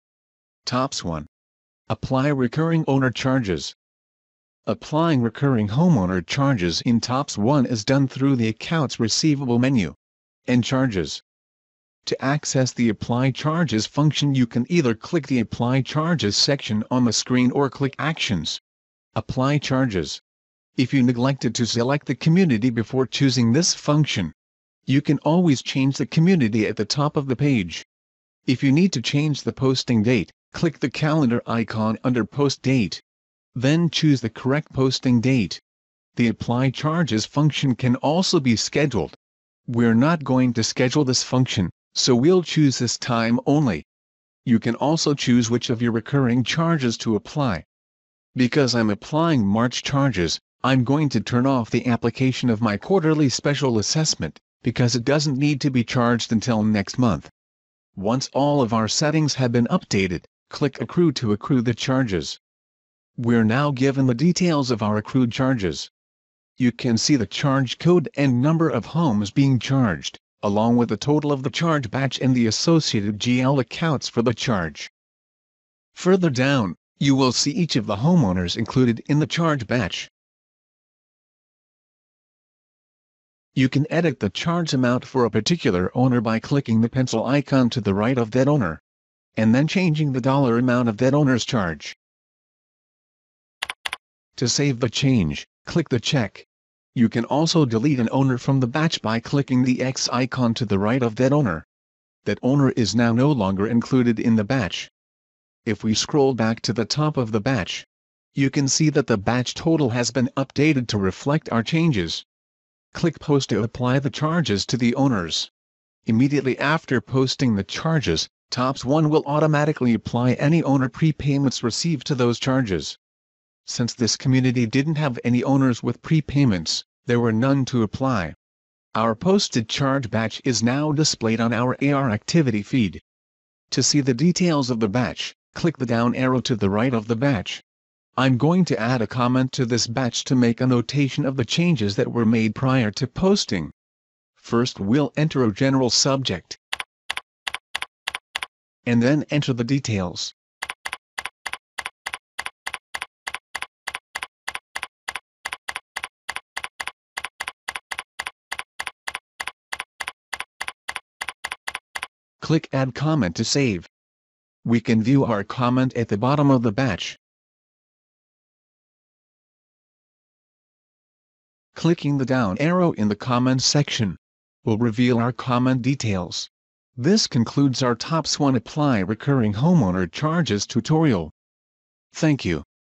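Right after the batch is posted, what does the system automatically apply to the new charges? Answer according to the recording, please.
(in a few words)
owner prepayments.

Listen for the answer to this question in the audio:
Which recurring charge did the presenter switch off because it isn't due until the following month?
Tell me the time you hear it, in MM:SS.
00:52.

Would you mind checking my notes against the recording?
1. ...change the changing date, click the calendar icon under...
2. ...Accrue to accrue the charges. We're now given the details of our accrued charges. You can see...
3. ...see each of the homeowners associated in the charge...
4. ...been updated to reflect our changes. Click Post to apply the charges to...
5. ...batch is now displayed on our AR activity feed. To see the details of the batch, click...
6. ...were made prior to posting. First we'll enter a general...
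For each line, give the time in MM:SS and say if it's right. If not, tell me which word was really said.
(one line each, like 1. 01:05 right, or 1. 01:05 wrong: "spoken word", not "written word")
1. 00:29 wrong: "posting", not "changing"
2. 01:00 right
3. 01:17 wrong: "included", not "associated"
4. 01:50 right
5. 02:10 right
6. 02:22 right.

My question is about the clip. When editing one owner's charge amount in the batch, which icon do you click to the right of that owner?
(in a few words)
pencil icon.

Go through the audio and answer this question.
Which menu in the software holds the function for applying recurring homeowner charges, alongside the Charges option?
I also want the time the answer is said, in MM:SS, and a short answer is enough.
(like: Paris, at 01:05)
Accounts Receivable, at 00:08.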